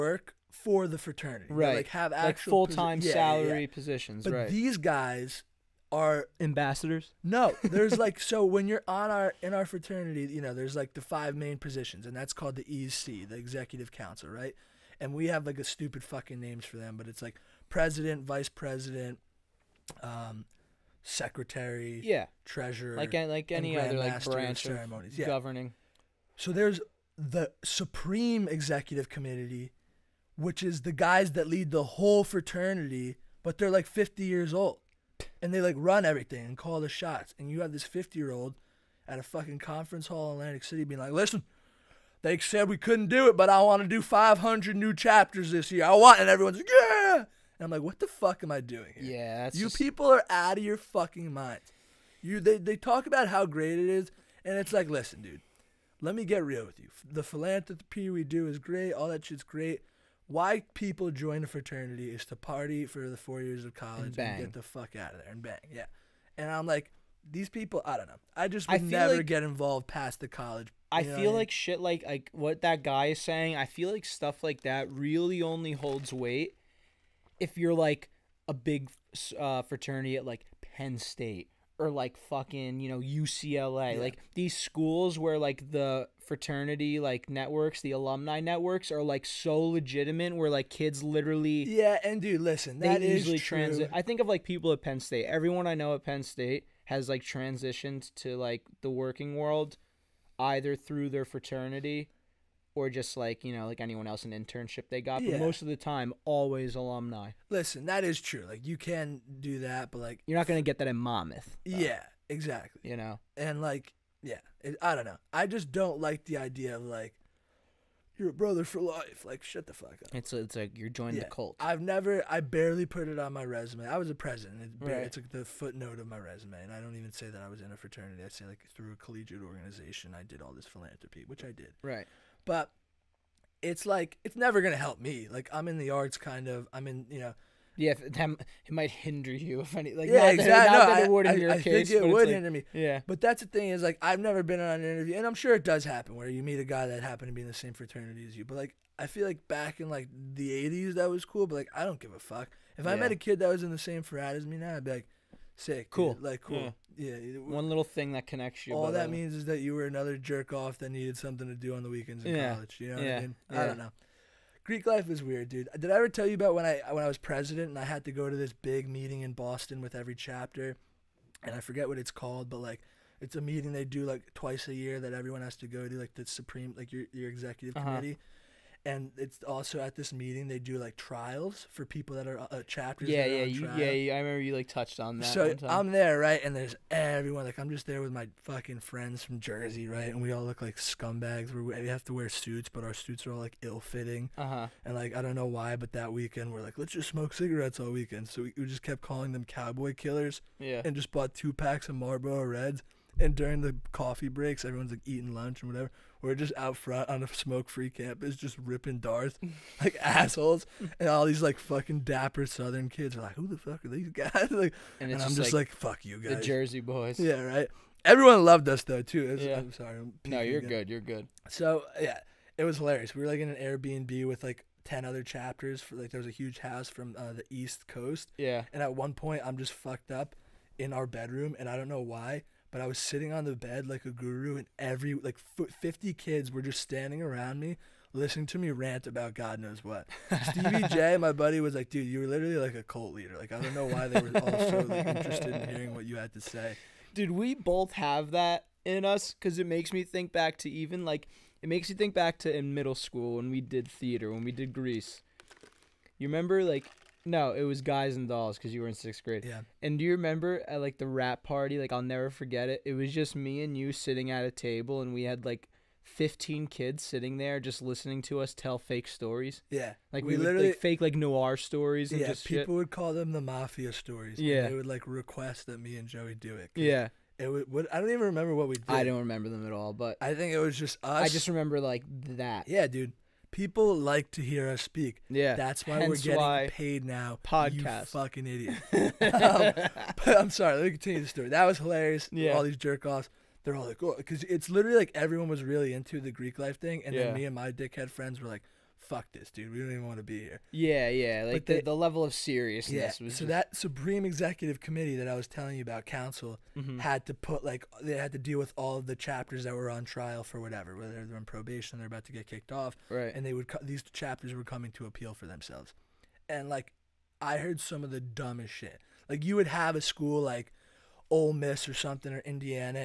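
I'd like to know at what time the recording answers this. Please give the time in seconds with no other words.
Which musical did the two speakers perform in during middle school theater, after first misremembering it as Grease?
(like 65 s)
257 s.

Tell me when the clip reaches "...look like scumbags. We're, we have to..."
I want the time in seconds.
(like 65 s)
190 s.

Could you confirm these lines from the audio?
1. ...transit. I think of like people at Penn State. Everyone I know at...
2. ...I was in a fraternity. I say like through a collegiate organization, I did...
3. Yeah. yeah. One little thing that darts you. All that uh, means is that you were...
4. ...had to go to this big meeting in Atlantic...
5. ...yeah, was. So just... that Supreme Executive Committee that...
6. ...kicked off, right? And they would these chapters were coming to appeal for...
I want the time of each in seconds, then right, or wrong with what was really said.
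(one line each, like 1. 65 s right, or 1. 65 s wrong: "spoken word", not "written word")
1. 93 s right
2. 127 s right
3. 156 s wrong: "connects", not "darts"
4. 167 s wrong: "Boston", not "Atlantic"
5. 303 s right
6. 312 s right.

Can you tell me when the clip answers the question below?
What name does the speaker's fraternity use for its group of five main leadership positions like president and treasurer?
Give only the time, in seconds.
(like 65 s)
13 s.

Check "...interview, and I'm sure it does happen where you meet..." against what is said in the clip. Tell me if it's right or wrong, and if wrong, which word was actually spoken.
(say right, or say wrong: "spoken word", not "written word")
right.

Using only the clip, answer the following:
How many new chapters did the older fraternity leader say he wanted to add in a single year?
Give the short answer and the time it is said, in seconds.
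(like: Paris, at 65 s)
500, at 44 s.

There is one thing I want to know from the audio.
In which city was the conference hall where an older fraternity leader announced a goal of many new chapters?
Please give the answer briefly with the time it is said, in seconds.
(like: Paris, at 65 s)
Atlantic City, at 40 s.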